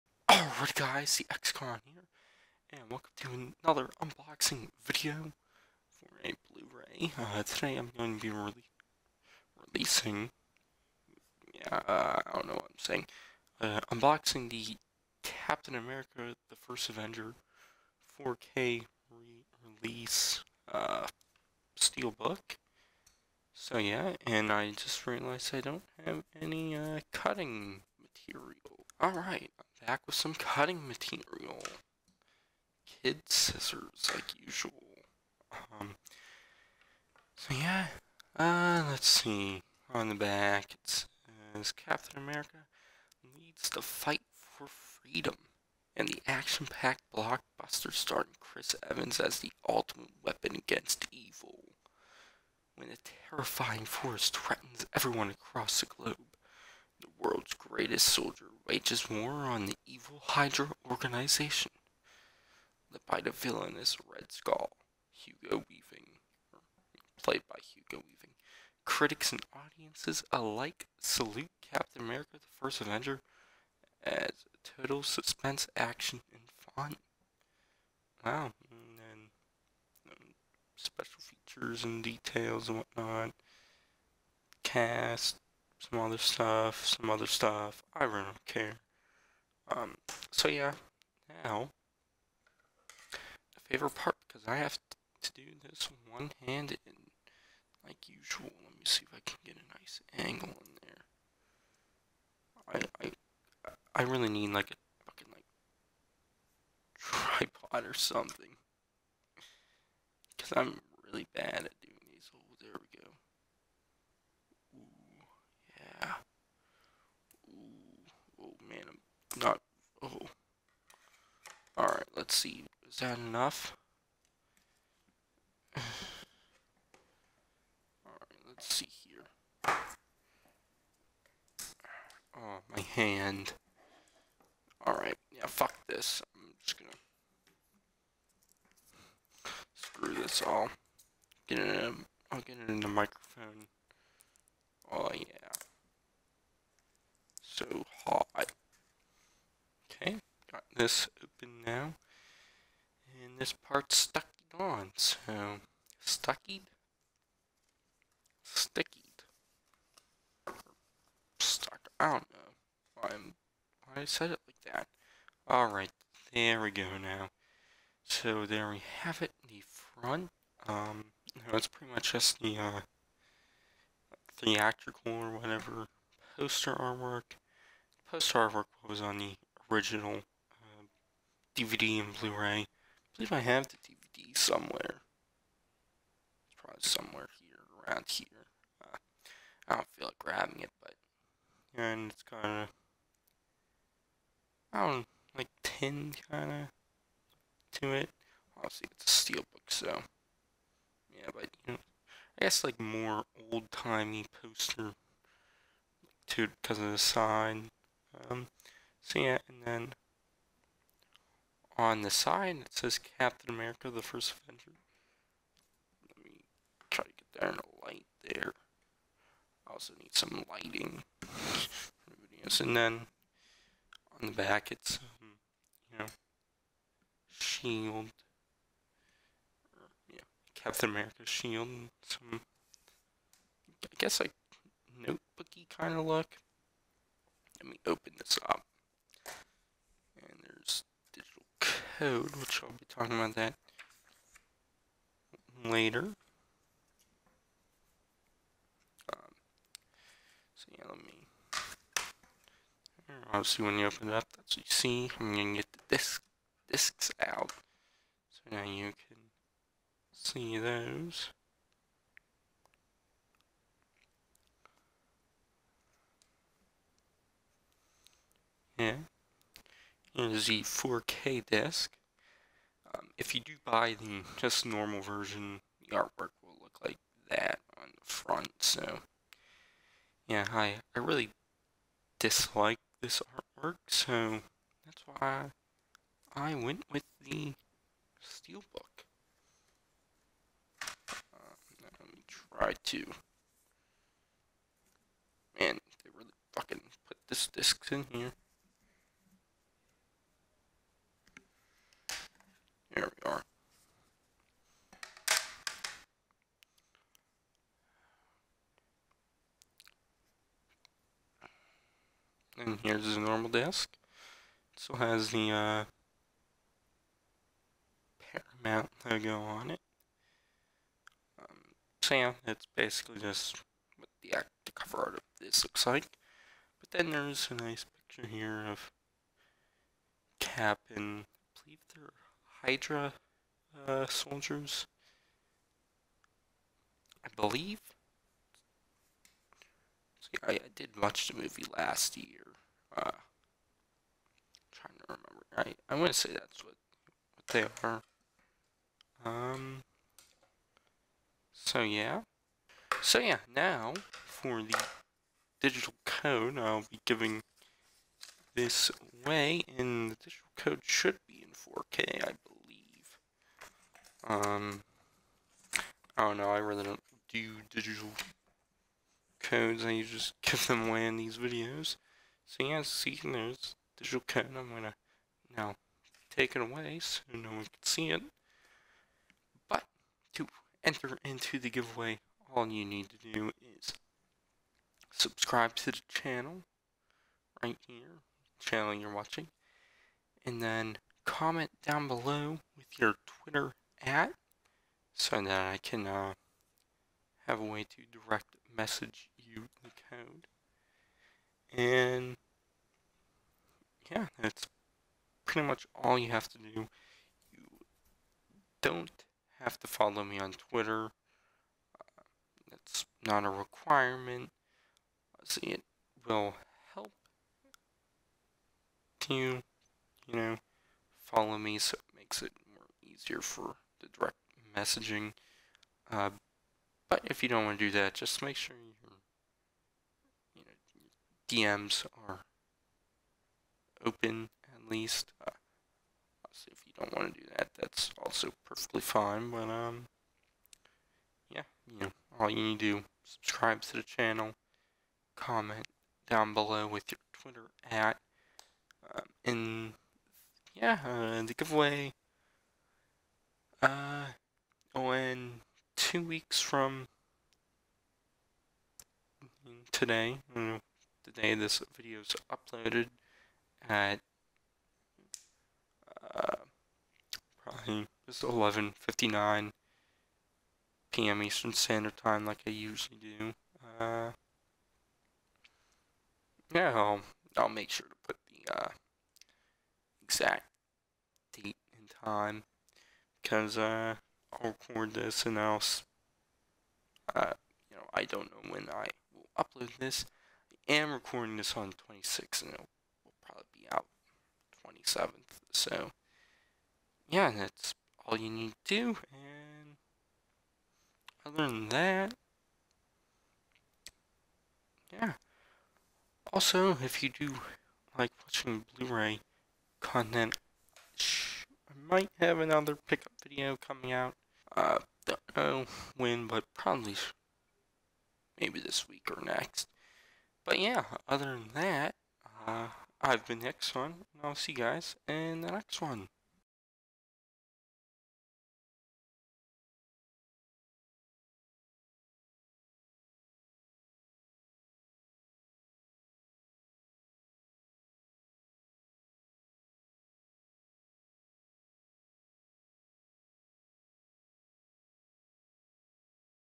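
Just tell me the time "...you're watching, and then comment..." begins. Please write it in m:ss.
6:28.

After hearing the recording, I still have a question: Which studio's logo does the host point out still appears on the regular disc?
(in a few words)
Paramount.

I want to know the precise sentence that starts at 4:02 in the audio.
code, which I'll be talking about that later.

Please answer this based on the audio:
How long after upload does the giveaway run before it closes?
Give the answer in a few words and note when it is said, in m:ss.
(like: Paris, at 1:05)
Two weeks, at 7:35.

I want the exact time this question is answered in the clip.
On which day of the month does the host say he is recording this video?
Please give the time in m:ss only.
8:12.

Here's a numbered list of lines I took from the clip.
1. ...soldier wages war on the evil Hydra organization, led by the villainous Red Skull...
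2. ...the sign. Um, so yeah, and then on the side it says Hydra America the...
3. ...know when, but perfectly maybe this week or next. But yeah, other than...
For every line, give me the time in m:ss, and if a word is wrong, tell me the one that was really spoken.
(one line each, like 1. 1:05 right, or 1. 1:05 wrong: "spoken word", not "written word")
1. 0:58 right
2. 3:26 wrong: "Captain", not "Hydra"
3. 8:35 wrong: "probably", not "perfectly".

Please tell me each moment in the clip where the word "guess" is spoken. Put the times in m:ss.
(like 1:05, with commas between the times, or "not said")
3:22, 3:53.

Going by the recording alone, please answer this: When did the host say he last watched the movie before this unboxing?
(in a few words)
Last year.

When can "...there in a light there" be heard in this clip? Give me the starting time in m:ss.
3:37.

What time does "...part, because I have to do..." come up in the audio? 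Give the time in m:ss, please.
1:33.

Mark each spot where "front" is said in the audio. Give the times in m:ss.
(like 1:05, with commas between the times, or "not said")
2:49, 4:38.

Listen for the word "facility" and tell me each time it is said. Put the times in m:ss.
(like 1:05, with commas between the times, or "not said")
not said.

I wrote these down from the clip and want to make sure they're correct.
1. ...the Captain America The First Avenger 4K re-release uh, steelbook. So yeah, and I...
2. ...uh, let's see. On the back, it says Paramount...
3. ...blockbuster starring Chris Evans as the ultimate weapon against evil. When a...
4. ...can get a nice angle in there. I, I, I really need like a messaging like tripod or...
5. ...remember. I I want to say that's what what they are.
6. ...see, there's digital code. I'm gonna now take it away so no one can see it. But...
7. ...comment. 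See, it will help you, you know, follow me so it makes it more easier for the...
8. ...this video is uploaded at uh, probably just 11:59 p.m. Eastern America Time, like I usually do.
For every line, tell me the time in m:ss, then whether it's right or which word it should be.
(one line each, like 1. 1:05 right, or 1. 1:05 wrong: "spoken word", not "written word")
1. 0:14 right
2. 0:38 wrong: "Captain", not "Paramount"
3. 0:47 right
4. 1:39 wrong: "fucking", not "messaging"
5. 5:45 right
6. 6:12 right
7. 6:53 wrong: "requirement", not "comment"
8. 7:41 wrong: "Standard", not "America".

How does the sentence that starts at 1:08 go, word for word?
Critics and audiences alike salute Captain America the First Avenger as total suspense, action, and fun.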